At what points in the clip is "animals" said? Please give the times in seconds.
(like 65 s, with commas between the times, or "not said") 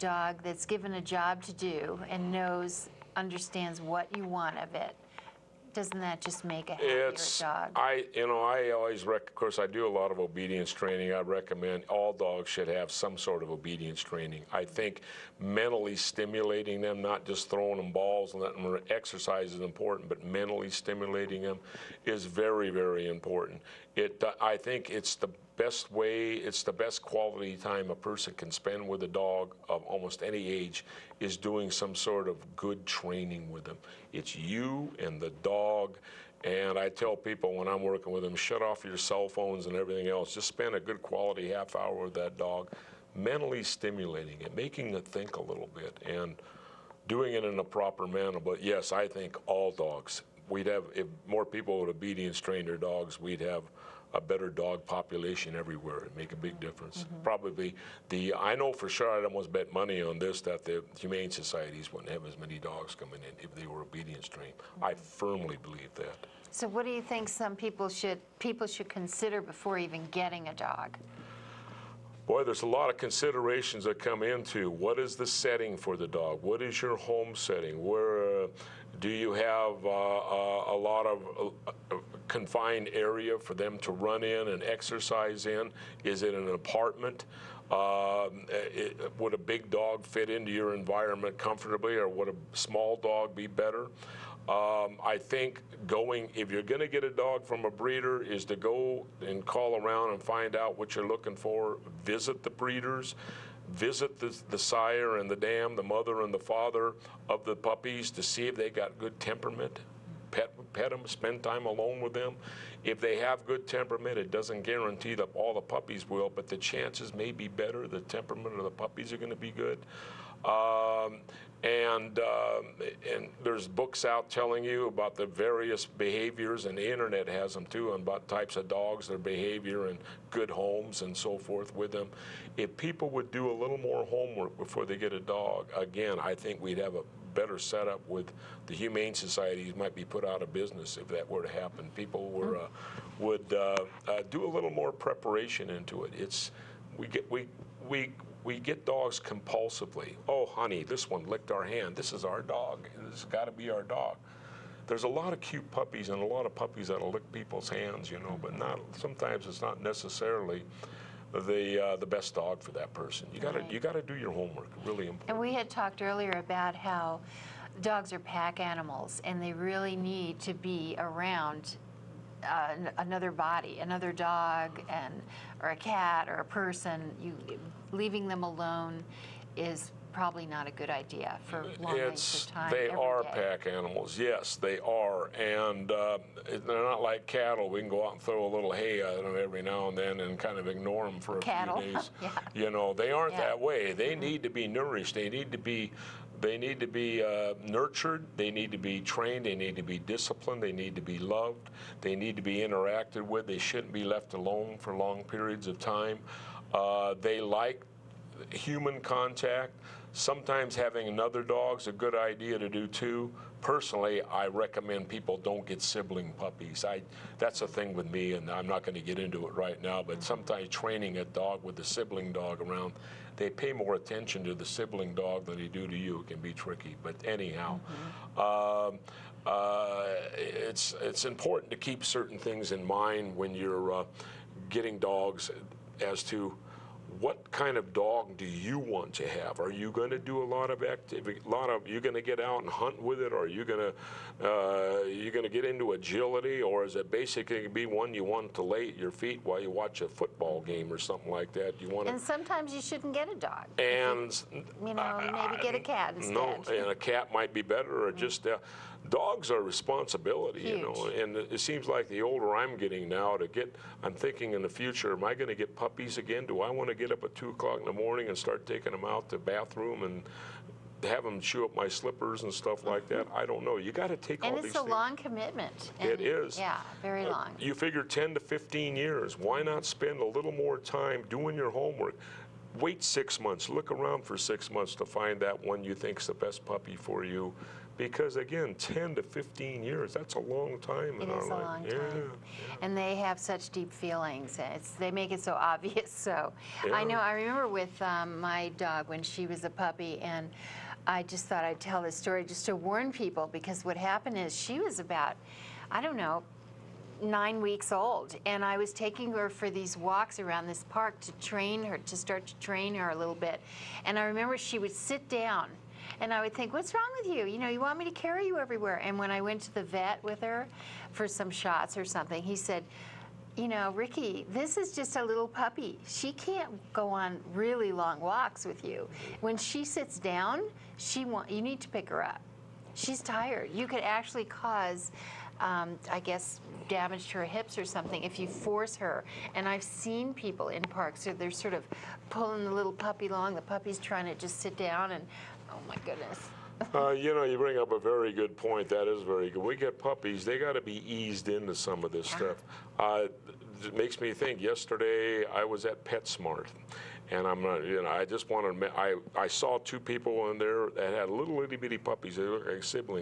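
168 s, 183 s.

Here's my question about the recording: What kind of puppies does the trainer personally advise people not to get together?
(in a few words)
sibling puppies.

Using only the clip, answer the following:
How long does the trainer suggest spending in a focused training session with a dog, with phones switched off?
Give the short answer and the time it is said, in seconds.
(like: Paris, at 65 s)
half hour, at 41 s.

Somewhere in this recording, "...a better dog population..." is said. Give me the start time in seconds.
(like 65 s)
54 s.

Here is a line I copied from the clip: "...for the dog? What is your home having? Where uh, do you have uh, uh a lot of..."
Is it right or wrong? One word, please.
wrong.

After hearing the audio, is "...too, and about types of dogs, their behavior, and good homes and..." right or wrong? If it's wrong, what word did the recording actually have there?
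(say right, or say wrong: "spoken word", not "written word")
right.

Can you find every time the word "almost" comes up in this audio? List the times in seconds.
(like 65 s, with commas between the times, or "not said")
29 s, 59 s.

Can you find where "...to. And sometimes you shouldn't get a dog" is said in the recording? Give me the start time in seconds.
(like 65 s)
252 s.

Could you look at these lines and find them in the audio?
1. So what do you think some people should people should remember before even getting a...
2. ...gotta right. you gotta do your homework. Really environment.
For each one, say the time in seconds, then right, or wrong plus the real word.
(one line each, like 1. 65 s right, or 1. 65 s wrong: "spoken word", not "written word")
1. 66 s wrong: "consider", not "remember"
2. 163 s wrong: "important", not "environment".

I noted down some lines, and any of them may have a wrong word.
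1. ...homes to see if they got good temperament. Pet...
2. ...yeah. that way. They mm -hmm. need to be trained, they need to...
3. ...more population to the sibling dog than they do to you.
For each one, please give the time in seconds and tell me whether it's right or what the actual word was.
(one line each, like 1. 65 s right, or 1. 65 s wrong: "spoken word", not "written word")
1. 107 s wrong: "puppies", not "homes"
2. 193 s wrong: "nourished", not "trained"
3. 223 s wrong: "attention", not "population".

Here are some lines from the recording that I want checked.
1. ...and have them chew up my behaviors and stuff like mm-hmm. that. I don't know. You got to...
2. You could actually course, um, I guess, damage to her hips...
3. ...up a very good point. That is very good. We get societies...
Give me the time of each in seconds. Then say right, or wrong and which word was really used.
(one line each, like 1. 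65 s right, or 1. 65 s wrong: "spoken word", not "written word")
1. 270 s wrong: "slippers", not "behaviors"
2. 333 s wrong: "cause", not "course"
3. 347 s wrong: "puppies", not "societies".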